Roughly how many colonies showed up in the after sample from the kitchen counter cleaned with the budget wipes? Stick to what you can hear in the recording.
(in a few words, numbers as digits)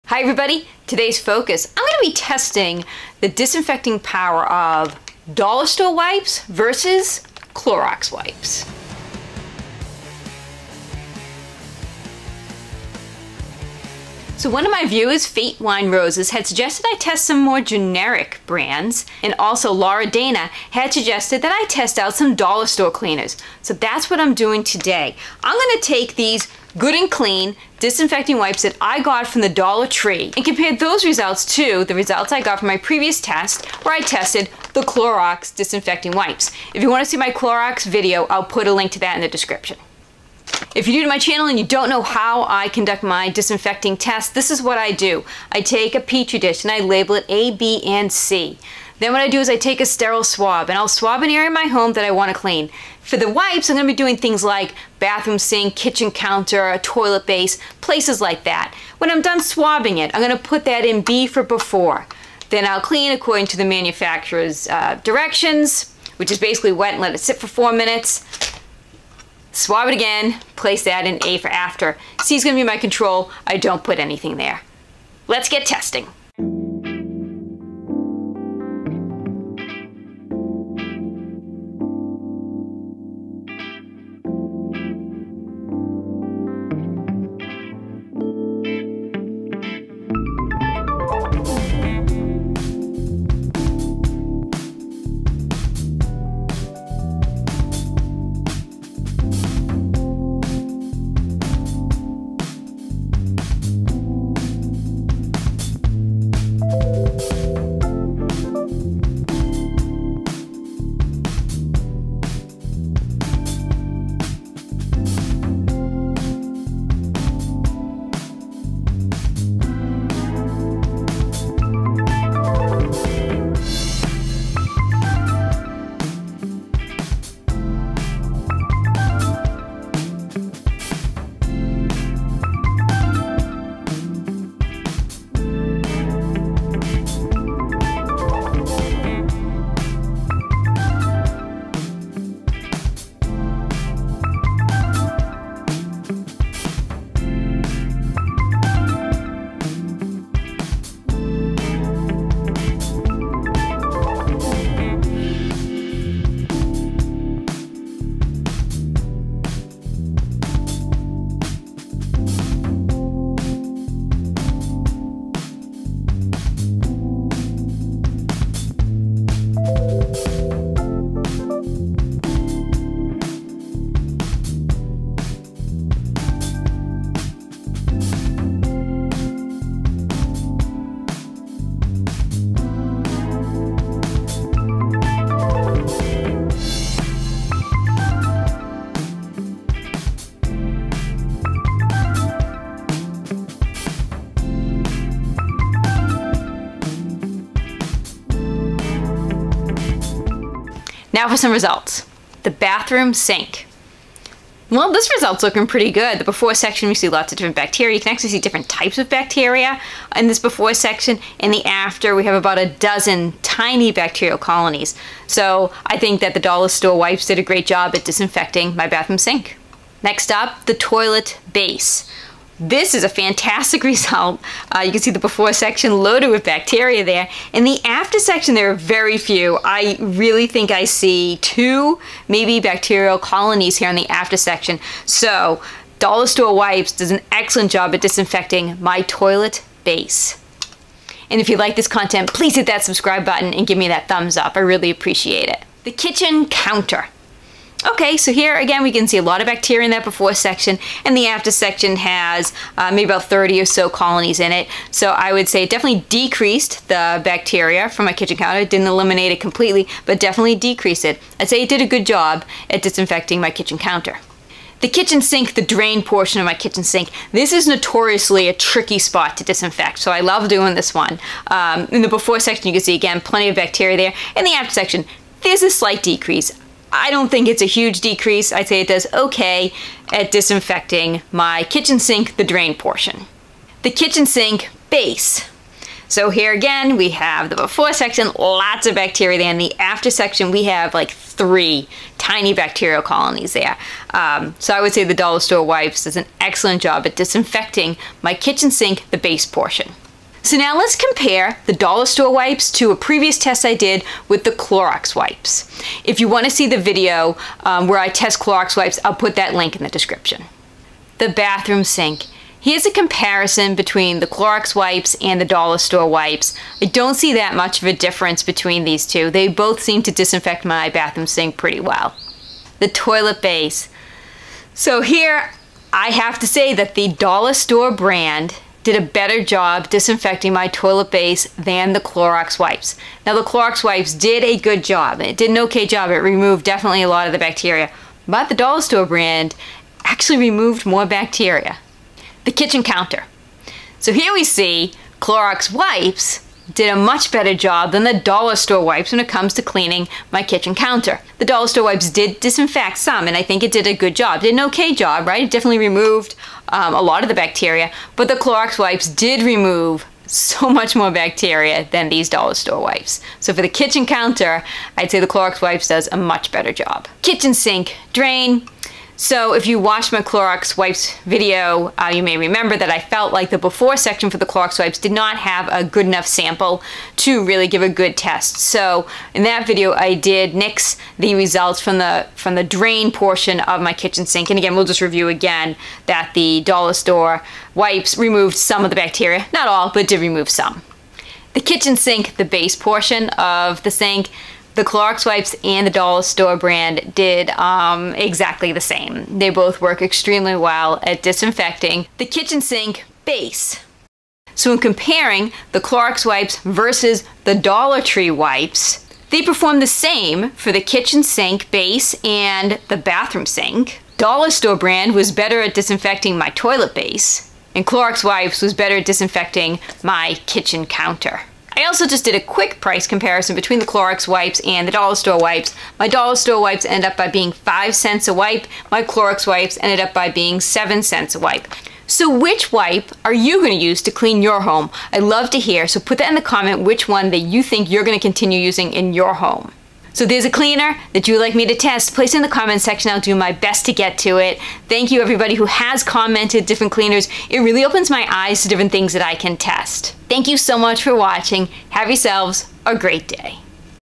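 about 30.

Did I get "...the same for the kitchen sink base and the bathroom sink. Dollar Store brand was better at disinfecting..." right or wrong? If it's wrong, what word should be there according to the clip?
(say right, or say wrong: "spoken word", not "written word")
right.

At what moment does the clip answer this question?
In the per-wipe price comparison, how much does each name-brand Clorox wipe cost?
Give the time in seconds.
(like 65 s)
430 s.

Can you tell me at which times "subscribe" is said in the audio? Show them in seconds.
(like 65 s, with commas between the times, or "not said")
242 s.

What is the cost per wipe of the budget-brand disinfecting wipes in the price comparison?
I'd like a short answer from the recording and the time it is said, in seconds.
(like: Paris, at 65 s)
5 cents, at 427 s.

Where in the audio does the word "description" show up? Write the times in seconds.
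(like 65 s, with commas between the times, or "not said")
39 s, 309 s.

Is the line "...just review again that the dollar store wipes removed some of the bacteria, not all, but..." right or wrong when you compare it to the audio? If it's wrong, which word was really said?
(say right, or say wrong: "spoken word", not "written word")
right.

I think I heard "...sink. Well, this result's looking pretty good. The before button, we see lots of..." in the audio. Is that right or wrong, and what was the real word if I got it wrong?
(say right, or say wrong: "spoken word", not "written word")
wrong: "section", not "button".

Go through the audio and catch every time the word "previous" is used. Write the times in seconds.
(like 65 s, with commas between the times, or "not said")
32 s, 302 s.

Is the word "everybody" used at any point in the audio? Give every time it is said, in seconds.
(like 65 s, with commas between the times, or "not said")
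0 s, 445 s.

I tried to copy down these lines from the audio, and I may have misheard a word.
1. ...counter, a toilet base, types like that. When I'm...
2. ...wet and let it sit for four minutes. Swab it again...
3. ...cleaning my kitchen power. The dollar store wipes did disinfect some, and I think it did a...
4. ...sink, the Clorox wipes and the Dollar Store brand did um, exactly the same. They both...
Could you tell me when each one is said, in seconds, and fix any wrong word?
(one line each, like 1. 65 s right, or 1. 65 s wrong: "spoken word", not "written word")
1. 56 s wrong: "places", not "types"
2. 66 s right
3. 349 s wrong: "counter", not "power"
4. 393 s right.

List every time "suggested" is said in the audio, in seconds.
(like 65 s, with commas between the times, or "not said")
16 s, 20 s.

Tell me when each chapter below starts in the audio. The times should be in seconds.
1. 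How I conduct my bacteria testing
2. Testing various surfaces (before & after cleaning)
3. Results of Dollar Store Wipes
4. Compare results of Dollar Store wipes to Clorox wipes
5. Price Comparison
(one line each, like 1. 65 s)
1. 42 s
2. 76 s
3. 198 s
4. 295 s
5. 422 s.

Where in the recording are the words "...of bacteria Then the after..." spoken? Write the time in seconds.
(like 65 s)
288 s.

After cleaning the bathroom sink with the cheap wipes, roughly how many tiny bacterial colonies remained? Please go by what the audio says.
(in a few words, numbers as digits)
about a dozen.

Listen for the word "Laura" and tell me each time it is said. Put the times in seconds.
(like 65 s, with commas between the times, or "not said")
19 s.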